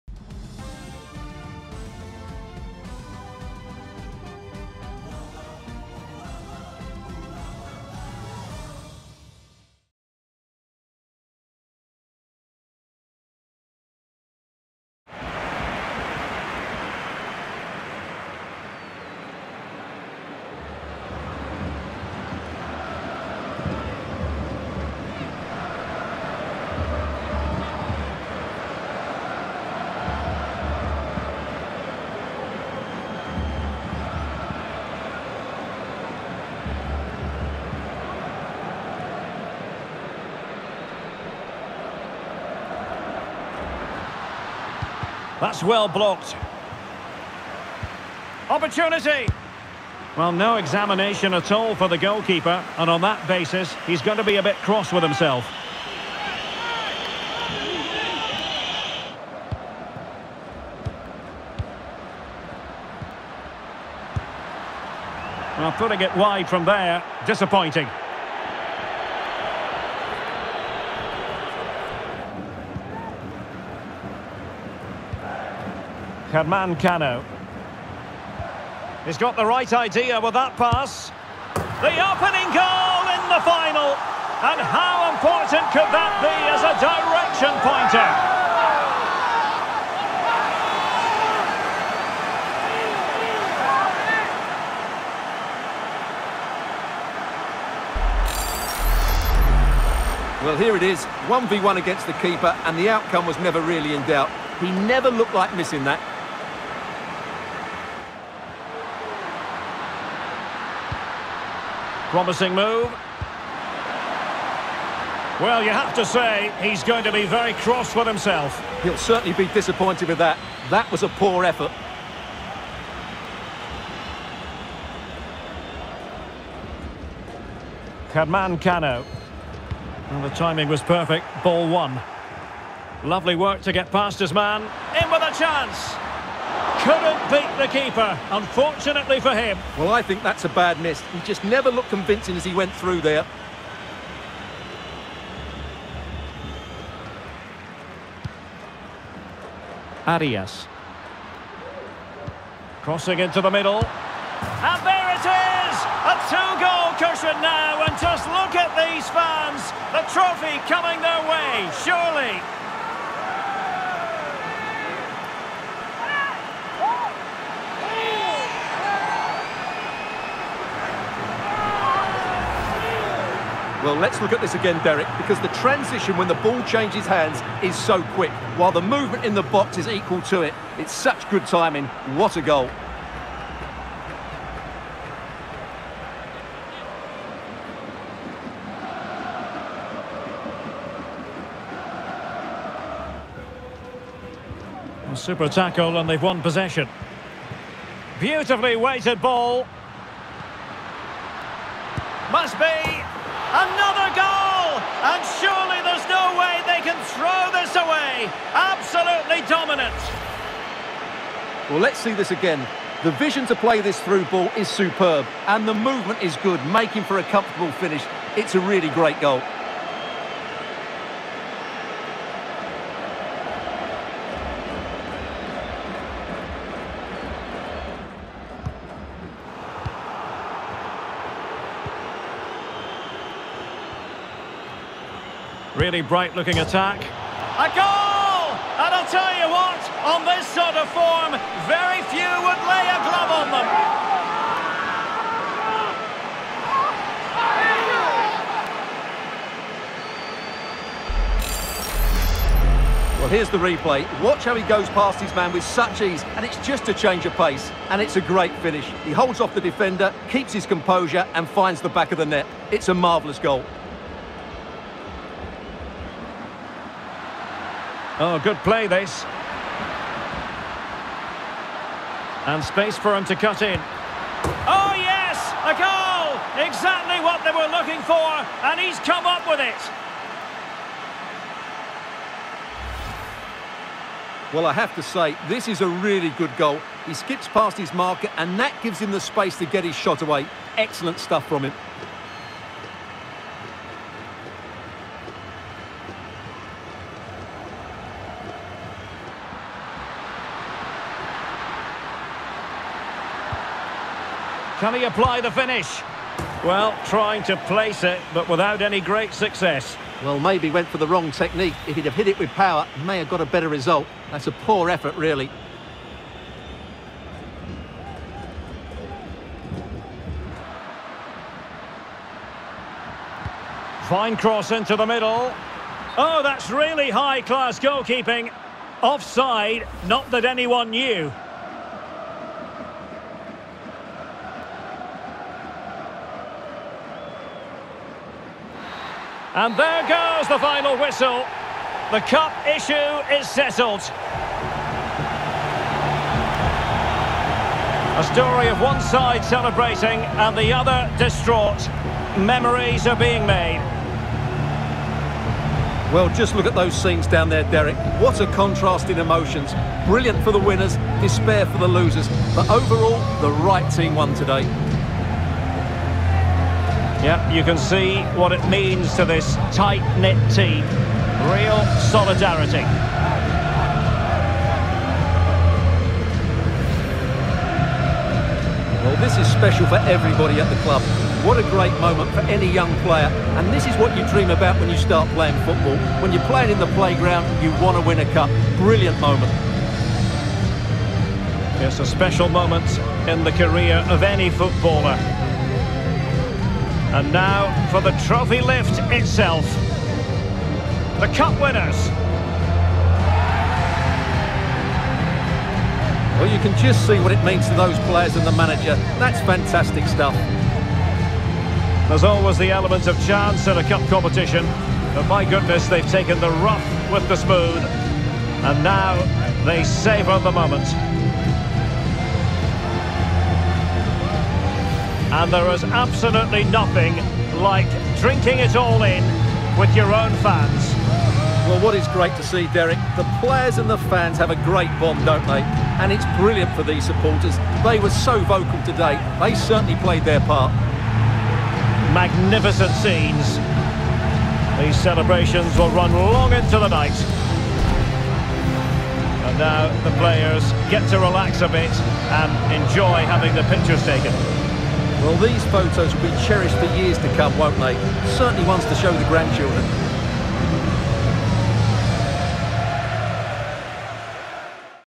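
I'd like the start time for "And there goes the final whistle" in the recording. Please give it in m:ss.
5:39.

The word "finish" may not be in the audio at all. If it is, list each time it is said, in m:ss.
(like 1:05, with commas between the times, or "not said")
3:37, 4:18, 5:05.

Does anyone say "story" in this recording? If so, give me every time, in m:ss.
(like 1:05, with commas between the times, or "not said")
5:48.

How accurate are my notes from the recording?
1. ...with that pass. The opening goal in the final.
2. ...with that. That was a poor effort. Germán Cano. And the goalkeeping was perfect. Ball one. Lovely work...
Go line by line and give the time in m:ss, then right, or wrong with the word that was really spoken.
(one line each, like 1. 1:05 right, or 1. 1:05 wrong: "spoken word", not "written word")
1. 1:20 right
2. 2:00 wrong: "timing", not "goalkeeping".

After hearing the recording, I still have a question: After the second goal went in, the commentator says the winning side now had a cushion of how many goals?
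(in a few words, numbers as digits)
2.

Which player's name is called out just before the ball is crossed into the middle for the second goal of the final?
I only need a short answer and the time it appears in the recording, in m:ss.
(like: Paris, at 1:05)
Arias, at 2:30.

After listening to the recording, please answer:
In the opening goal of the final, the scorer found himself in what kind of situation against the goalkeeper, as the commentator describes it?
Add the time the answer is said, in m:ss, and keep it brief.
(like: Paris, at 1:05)
1v1, at 1:41.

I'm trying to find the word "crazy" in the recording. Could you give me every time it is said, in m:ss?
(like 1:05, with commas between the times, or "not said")
not said.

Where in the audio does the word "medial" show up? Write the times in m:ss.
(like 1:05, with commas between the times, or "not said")
not said.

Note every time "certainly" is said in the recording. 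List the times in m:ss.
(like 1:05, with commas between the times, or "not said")
1:58, 7:19, 7:38.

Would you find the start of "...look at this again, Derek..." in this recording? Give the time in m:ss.
2:54.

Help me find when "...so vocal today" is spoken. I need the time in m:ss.
7:18.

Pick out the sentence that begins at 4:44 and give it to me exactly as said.
Well, I have to say, this is a really good goal.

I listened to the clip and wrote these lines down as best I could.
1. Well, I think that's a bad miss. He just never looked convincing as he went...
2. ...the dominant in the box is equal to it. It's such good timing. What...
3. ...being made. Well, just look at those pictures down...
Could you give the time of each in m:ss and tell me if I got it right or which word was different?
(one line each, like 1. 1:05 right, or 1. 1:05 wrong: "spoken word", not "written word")
1. 2:19 right
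2. 2:58 wrong: "movement", not "dominant"
3. 5:53 wrong: "scenes", not "pictures".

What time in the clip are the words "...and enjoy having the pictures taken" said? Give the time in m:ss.
7:32.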